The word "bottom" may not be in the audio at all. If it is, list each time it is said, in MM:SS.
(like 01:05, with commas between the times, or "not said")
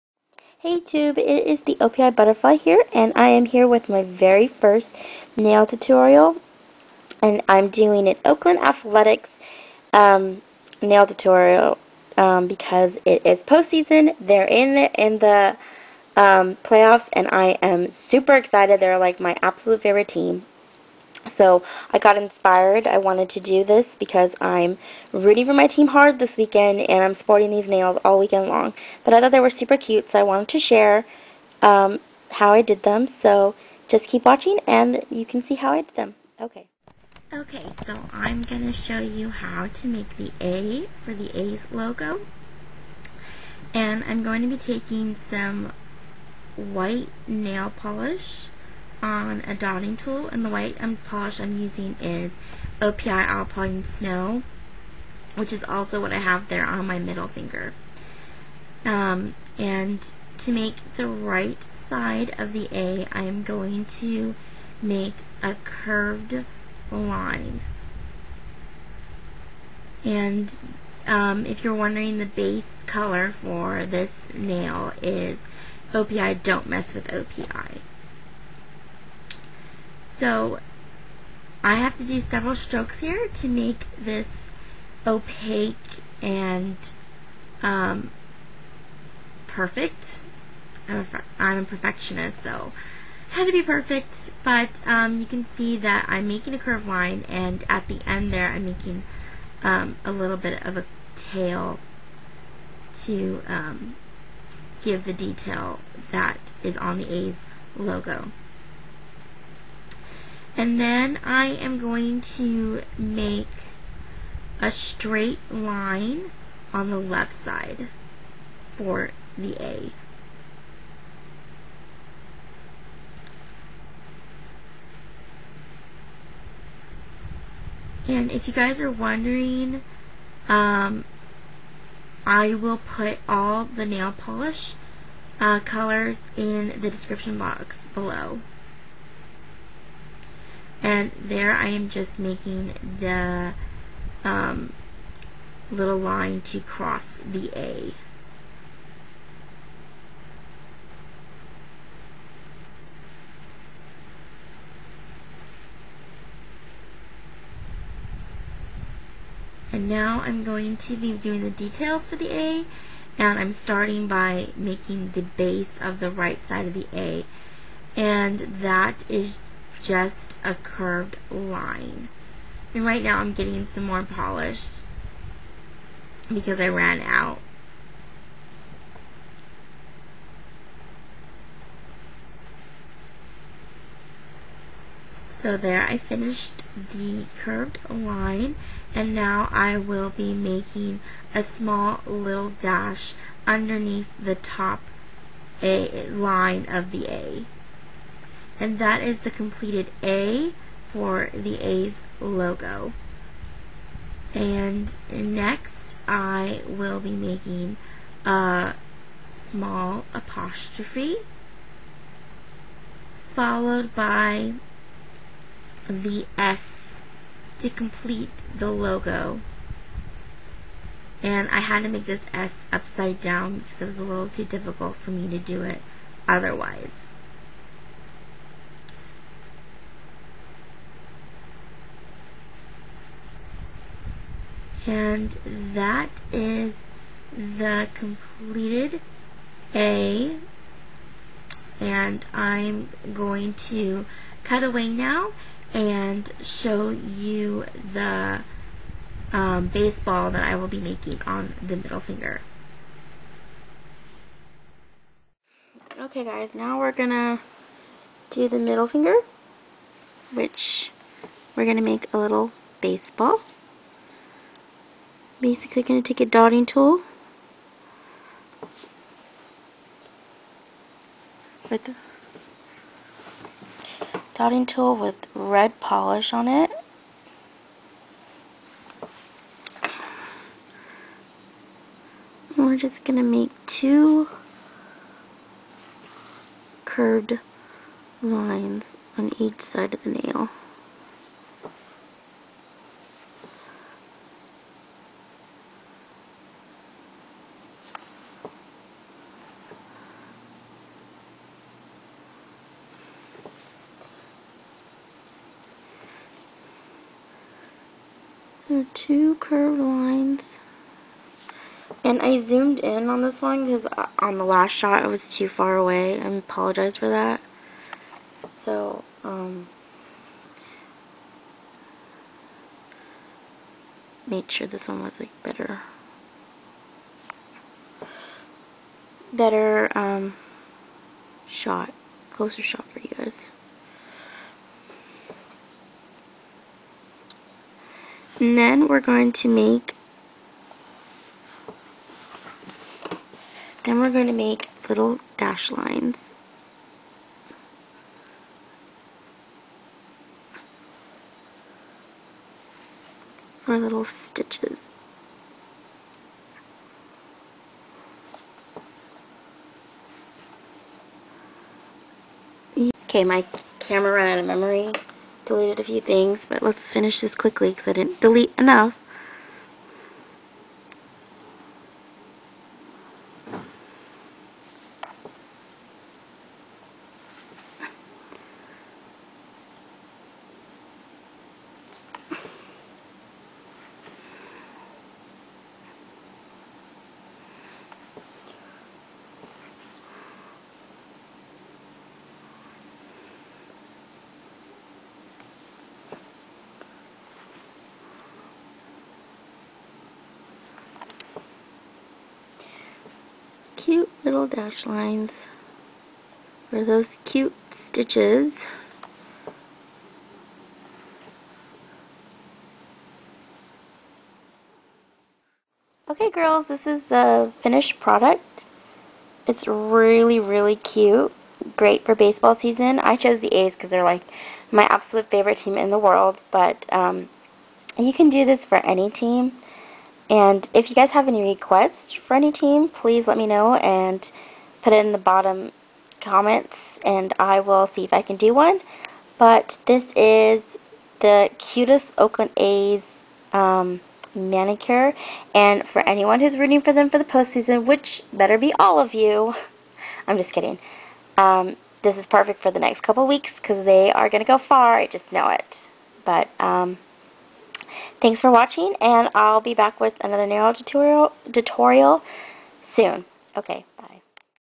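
07:15.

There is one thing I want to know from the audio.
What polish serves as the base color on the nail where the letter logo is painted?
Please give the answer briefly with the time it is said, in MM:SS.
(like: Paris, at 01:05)
OPI Don't Mess with OPI, at 01:15.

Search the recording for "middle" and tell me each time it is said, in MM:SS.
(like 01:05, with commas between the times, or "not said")
00:56, 04:11, 04:18.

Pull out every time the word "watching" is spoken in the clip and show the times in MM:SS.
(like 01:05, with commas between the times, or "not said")
00:34, 07:38.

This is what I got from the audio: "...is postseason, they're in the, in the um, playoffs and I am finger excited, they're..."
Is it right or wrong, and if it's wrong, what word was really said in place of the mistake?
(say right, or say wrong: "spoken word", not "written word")
wrong: "super", not "finger".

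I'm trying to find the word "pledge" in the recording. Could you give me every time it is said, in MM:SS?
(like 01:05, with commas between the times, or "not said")
not said.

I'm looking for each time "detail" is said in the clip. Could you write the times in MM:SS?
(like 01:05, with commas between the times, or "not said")
01:45, 02:41.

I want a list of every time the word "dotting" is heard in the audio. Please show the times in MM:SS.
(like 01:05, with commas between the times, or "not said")
00:49, 04:26, 04:34.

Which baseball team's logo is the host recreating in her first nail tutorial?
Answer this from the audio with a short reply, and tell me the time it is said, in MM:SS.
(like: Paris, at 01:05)
Oakland Athletics, at 00:08.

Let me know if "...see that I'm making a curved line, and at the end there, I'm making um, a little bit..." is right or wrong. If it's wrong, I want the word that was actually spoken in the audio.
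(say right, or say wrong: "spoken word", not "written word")
right.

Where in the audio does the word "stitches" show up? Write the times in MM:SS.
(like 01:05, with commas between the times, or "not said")
05:54, 06:47.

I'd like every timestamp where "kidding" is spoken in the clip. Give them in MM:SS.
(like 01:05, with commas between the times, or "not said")
07:30.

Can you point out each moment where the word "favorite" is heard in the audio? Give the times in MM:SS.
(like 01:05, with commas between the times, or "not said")
00:19, 07:05.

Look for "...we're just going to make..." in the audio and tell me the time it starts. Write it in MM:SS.
04:42.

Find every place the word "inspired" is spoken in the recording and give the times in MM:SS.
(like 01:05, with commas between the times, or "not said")
00:22.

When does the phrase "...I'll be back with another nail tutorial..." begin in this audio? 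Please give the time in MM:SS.
07:39.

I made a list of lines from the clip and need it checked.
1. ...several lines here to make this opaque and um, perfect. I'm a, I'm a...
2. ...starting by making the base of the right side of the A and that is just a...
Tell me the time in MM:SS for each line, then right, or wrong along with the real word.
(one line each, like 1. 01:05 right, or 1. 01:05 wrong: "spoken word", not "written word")
1. 01:22 wrong: "strokes", not "lines"
2. 02:43 right.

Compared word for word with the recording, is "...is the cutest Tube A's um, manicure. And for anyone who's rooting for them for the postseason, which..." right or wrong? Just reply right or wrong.
wrong.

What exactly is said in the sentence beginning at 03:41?
And I had to make this S upside down because it was a little too difficult for me to do it otherwise.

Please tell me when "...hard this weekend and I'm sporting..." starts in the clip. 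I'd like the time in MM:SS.
00:25.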